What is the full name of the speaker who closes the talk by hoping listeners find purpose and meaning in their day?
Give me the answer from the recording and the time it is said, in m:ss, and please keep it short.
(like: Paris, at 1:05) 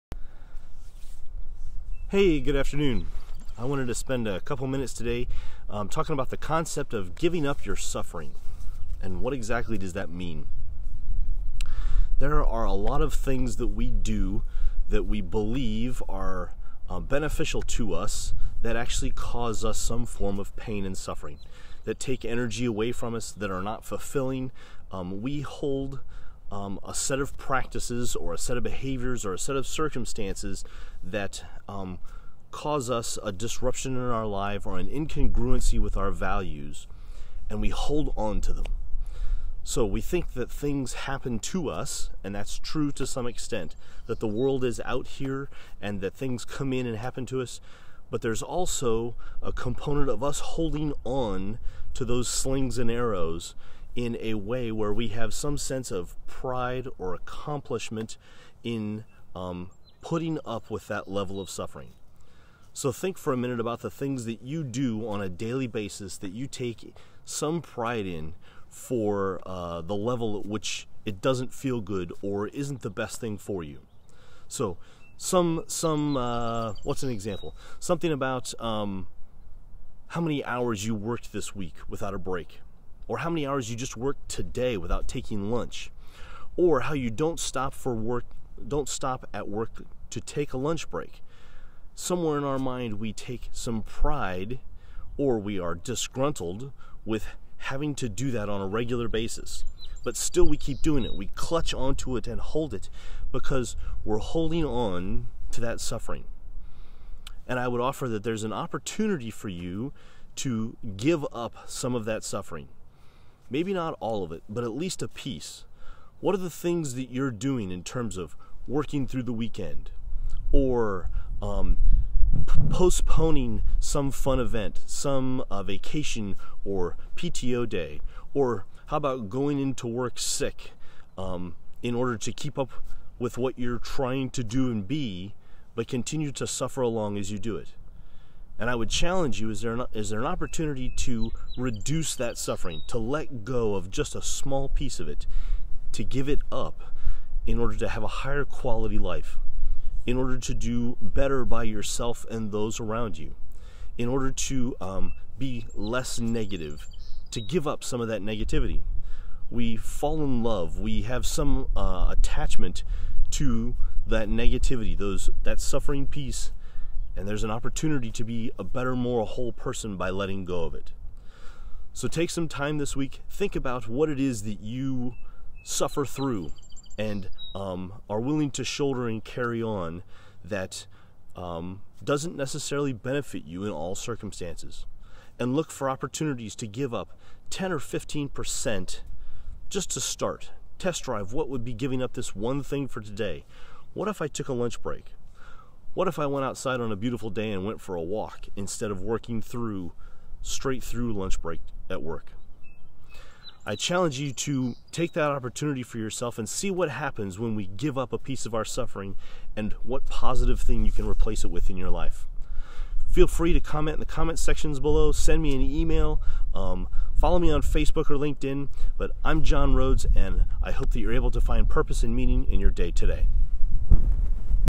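John Rhoads, at 3:39.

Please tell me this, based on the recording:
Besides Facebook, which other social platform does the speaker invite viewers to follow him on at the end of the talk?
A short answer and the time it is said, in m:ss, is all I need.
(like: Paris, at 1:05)
LinkedIn, at 3:38.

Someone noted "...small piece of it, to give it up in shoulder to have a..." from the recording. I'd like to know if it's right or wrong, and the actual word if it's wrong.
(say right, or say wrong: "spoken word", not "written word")
wrong: "order", not "shoulder".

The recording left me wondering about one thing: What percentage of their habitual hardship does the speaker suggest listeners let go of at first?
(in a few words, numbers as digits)
10 or 15%.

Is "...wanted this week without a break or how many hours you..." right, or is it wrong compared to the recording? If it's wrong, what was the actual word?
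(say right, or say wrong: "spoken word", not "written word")
wrong: "worked", not "wanted".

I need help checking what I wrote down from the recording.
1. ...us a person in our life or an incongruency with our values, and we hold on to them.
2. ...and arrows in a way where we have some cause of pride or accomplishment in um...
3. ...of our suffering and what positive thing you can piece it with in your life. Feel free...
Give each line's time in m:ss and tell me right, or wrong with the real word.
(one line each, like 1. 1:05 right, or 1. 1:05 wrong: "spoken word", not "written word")
1. 0:32 wrong: "disruption", not "person"
2. 0:52 wrong: "sense", not "cause"
3. 3:28 wrong: "replace", not "piece".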